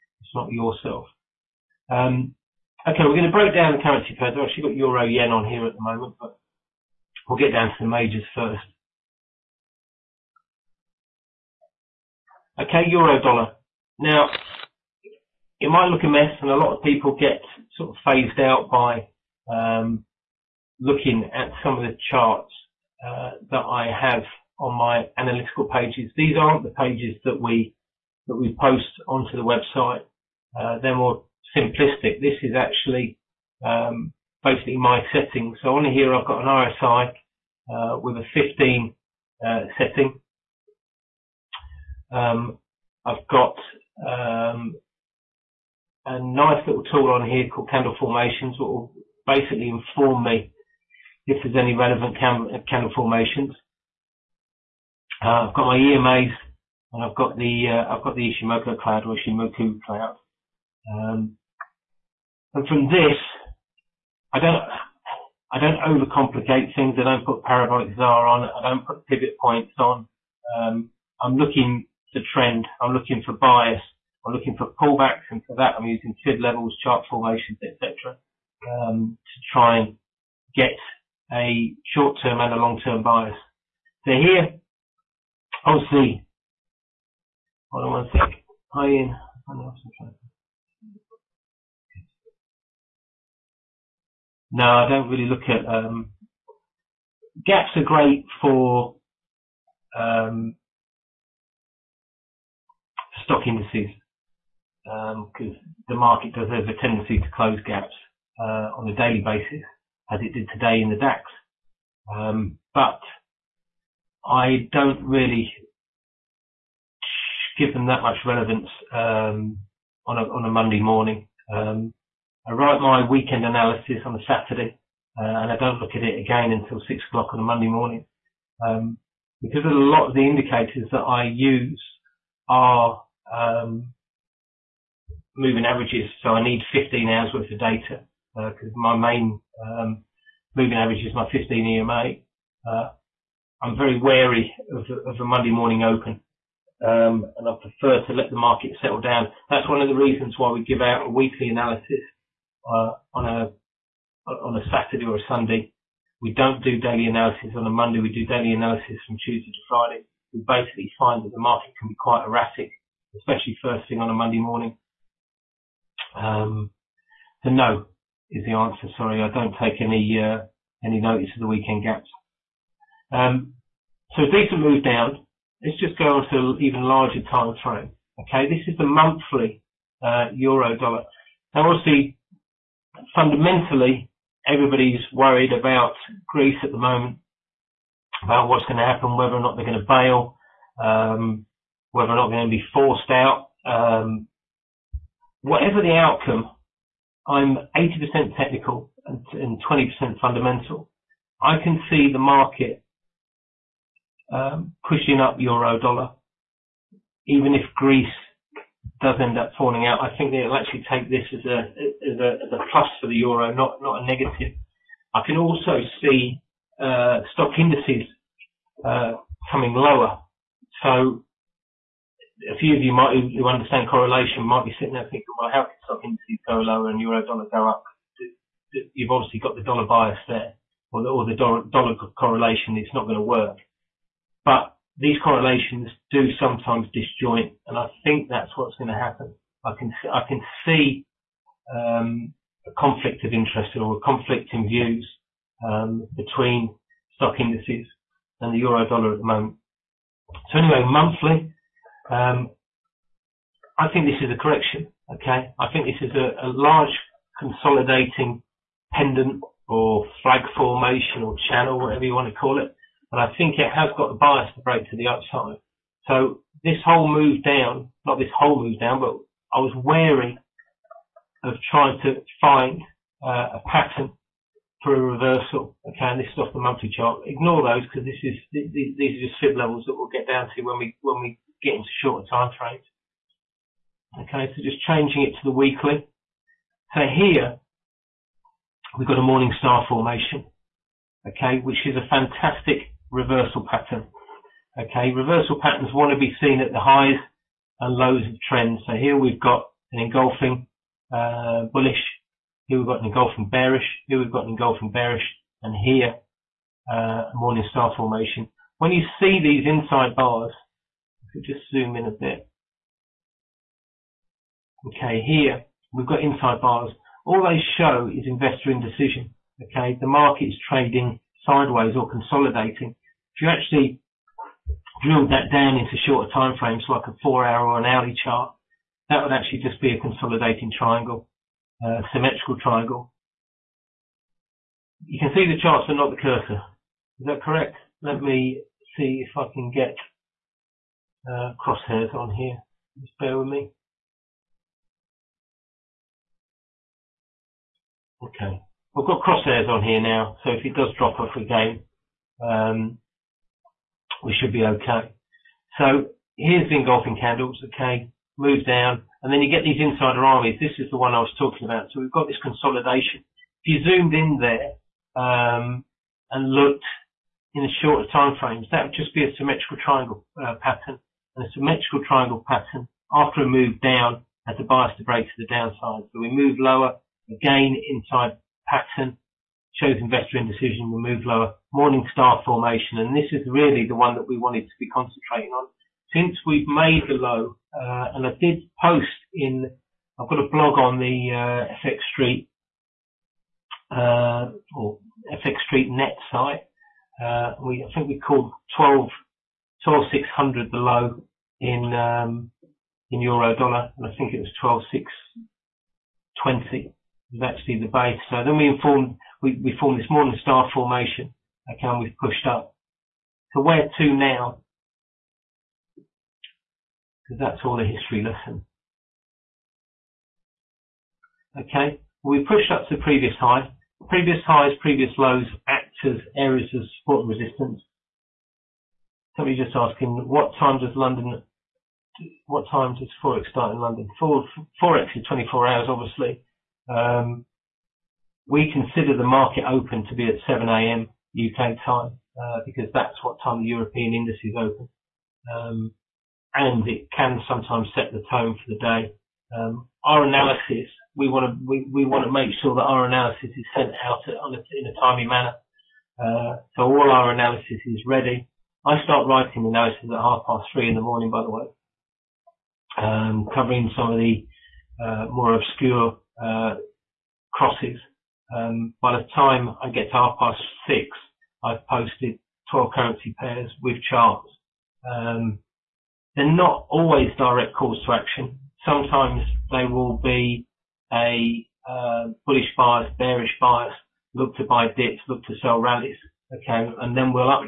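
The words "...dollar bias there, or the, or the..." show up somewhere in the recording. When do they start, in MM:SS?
03:49.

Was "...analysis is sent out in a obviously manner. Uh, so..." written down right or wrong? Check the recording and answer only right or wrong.
wrong.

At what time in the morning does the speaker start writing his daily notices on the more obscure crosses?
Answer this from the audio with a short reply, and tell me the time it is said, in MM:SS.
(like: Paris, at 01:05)
3:30 a.m., at 07:40.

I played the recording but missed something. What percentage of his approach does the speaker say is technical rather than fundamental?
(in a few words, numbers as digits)
80%.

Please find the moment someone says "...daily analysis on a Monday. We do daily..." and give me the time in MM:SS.
02:36.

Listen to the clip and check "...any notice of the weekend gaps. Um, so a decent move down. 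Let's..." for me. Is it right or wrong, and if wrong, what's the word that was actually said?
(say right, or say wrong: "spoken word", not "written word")
right.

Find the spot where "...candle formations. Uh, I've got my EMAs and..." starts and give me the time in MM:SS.
00:52.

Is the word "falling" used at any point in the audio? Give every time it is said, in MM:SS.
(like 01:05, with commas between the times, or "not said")
03:29.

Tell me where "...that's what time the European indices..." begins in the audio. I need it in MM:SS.
07:22.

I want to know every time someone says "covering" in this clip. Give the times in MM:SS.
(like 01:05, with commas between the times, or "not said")
07:43.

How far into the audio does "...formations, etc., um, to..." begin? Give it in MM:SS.
01:17.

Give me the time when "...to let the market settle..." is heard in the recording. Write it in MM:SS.
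02:28.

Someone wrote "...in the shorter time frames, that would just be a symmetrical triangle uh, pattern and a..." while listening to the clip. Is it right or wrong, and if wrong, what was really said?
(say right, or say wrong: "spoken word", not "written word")
right.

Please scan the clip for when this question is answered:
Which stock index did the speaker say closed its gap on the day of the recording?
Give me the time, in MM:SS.
01:50.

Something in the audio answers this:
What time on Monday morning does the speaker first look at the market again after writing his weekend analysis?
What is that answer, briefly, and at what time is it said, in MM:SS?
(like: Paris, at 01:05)
6:00, at 02:06.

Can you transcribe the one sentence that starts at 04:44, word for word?
Okay, so just changing it to the weekly.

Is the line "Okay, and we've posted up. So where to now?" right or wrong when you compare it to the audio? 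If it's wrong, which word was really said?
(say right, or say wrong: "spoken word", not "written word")
wrong: "pushed", not "posted".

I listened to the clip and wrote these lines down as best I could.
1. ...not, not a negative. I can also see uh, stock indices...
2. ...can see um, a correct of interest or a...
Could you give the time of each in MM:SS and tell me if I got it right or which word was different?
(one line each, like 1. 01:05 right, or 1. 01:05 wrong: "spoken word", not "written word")
1. 03:33 right
2. 04:00 wrong: "conflict", not "correct".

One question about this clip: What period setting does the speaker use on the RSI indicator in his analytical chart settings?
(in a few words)
15.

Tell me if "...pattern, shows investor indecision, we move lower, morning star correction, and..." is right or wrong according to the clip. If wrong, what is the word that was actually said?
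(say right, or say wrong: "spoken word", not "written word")
wrong: "formation", not "correction".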